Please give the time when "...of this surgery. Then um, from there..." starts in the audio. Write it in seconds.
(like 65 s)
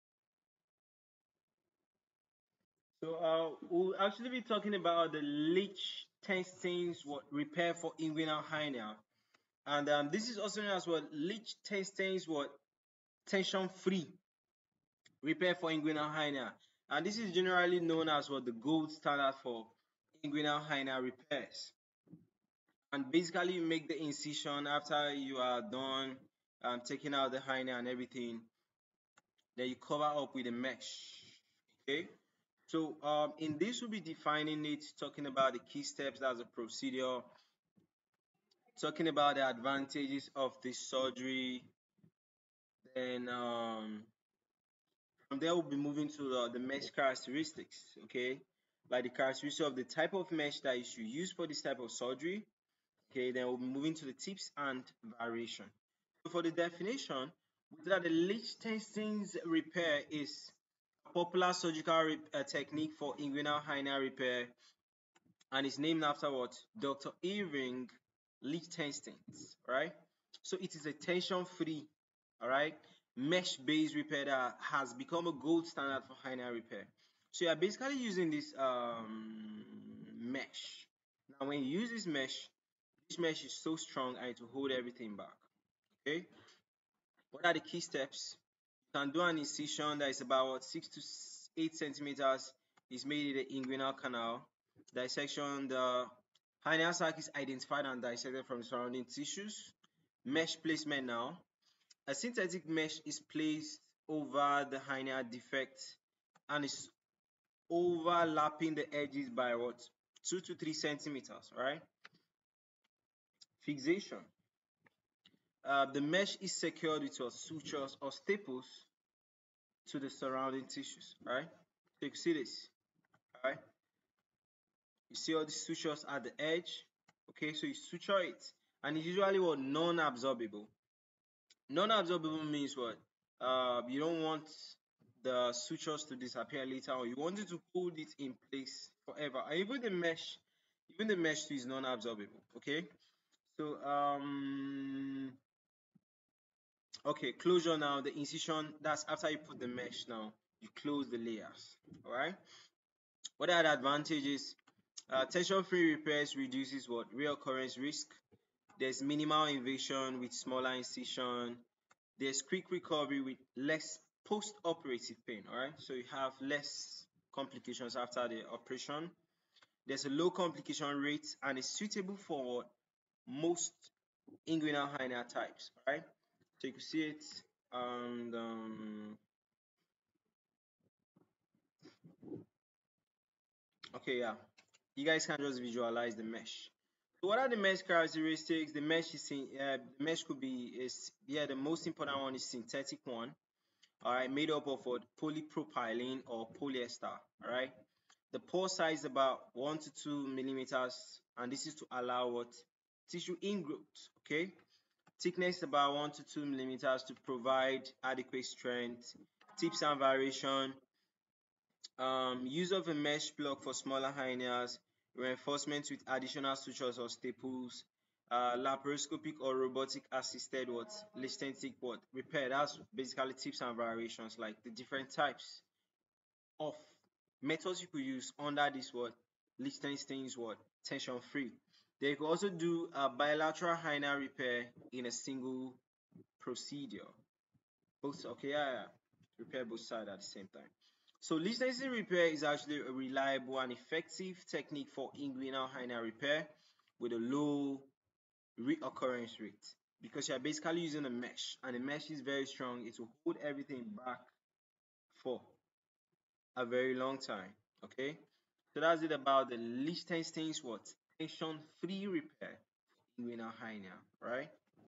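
40 s.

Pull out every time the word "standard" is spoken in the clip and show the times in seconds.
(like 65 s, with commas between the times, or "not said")
18 s, 75 s.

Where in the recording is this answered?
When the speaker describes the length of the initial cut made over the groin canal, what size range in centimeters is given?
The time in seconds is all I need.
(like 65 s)
90 s.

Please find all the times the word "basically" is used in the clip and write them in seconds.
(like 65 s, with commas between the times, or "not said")
23 s, 77 s, 222 s, 250 s.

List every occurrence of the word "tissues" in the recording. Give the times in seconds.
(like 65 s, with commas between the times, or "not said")
99 s, 120 s, 203 s.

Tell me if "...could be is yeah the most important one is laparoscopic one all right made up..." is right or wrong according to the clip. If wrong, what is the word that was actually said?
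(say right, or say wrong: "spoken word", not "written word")
wrong: "synthetic", not "laparoscopic".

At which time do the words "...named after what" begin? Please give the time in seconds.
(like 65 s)
65 s.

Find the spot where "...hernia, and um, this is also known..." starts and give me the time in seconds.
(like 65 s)
8 s.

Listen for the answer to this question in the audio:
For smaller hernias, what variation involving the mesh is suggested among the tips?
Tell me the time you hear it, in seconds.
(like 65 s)
212 s.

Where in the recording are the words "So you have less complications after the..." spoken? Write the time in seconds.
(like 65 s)
165 s.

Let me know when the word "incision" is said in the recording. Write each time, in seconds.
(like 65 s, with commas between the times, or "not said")
23 s, 89 s, 148 s, 160 s.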